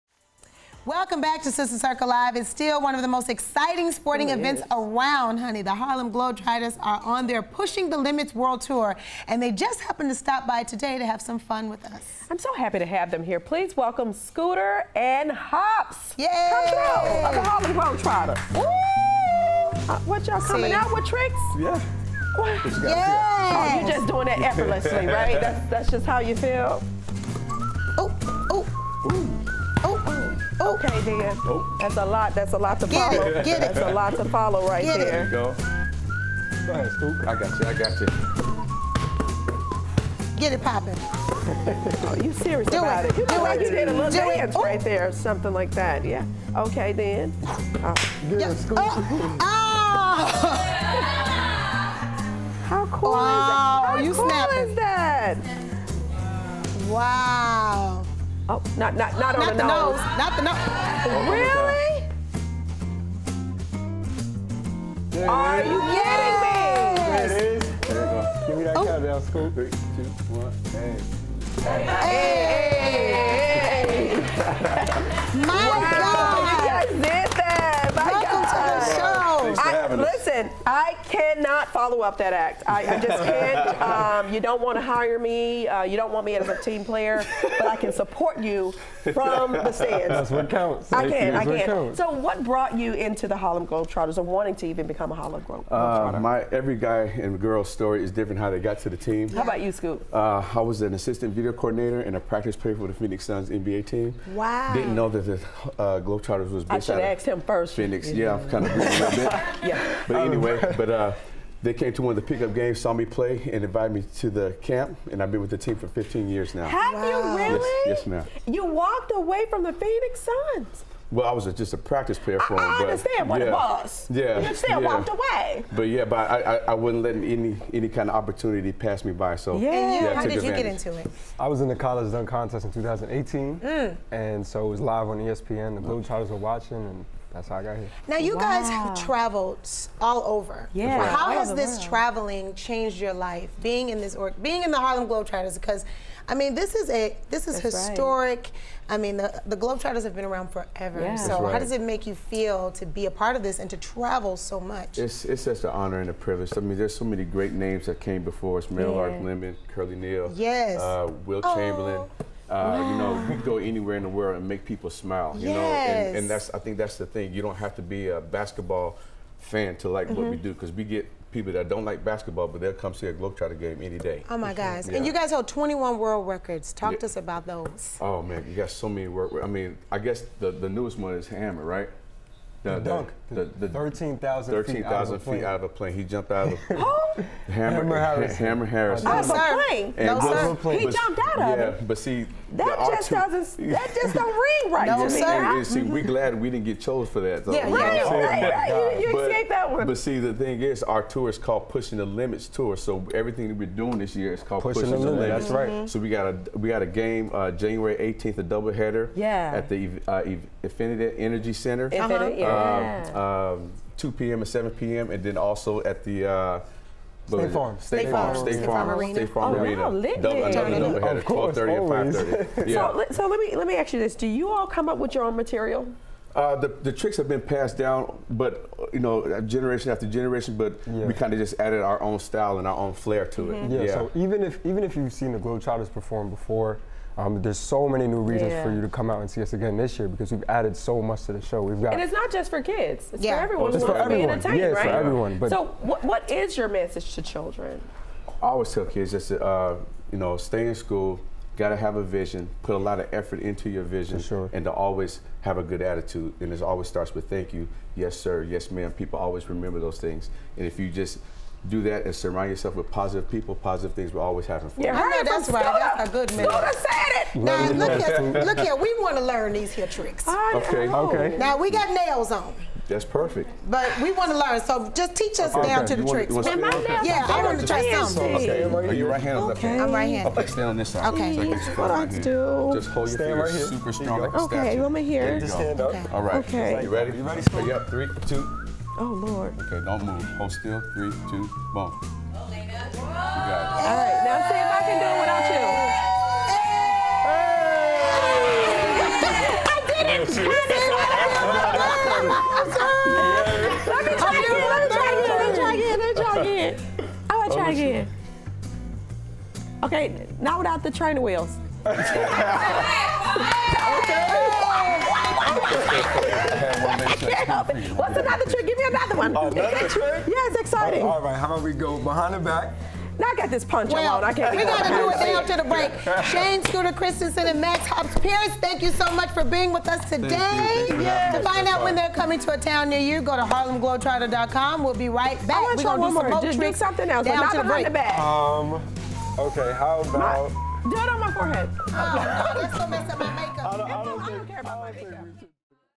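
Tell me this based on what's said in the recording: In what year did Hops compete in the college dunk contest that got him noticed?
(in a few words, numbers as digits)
2018.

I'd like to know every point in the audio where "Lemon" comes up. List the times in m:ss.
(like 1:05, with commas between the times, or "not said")
2:39.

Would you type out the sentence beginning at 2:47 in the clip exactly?
You don't have to be a basketball fan to like mm -hmm.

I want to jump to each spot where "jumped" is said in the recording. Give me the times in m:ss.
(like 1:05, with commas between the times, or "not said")
3:06, 3:10.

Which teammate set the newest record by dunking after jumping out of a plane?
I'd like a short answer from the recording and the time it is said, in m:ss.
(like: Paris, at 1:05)
Hammer Harrison, at 3:08.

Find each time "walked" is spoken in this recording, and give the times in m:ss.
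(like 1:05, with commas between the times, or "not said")
1:58, 2:04.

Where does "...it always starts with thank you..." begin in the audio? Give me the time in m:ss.
4:16.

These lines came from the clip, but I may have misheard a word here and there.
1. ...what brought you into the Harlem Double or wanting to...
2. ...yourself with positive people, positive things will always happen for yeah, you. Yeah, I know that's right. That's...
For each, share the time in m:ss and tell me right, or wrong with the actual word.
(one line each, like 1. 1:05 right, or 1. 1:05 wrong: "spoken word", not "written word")
1. 1:32 wrong: "Globetrotters", not "Double"
2. 4:22 right.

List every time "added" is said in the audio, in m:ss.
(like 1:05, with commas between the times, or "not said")
3:51, 4:00.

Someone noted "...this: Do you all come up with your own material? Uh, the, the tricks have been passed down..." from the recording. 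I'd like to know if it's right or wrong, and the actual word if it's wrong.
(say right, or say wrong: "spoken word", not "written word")
right.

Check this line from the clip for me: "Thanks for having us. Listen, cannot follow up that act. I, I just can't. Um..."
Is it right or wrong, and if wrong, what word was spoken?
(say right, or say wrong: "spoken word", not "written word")
right.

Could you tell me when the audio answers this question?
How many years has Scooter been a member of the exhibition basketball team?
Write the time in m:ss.
1:55.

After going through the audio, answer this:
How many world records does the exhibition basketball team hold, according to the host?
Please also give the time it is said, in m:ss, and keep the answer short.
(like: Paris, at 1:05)
21, at 2:55.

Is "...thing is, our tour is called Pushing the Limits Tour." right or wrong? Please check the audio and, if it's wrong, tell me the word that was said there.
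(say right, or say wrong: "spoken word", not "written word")
right.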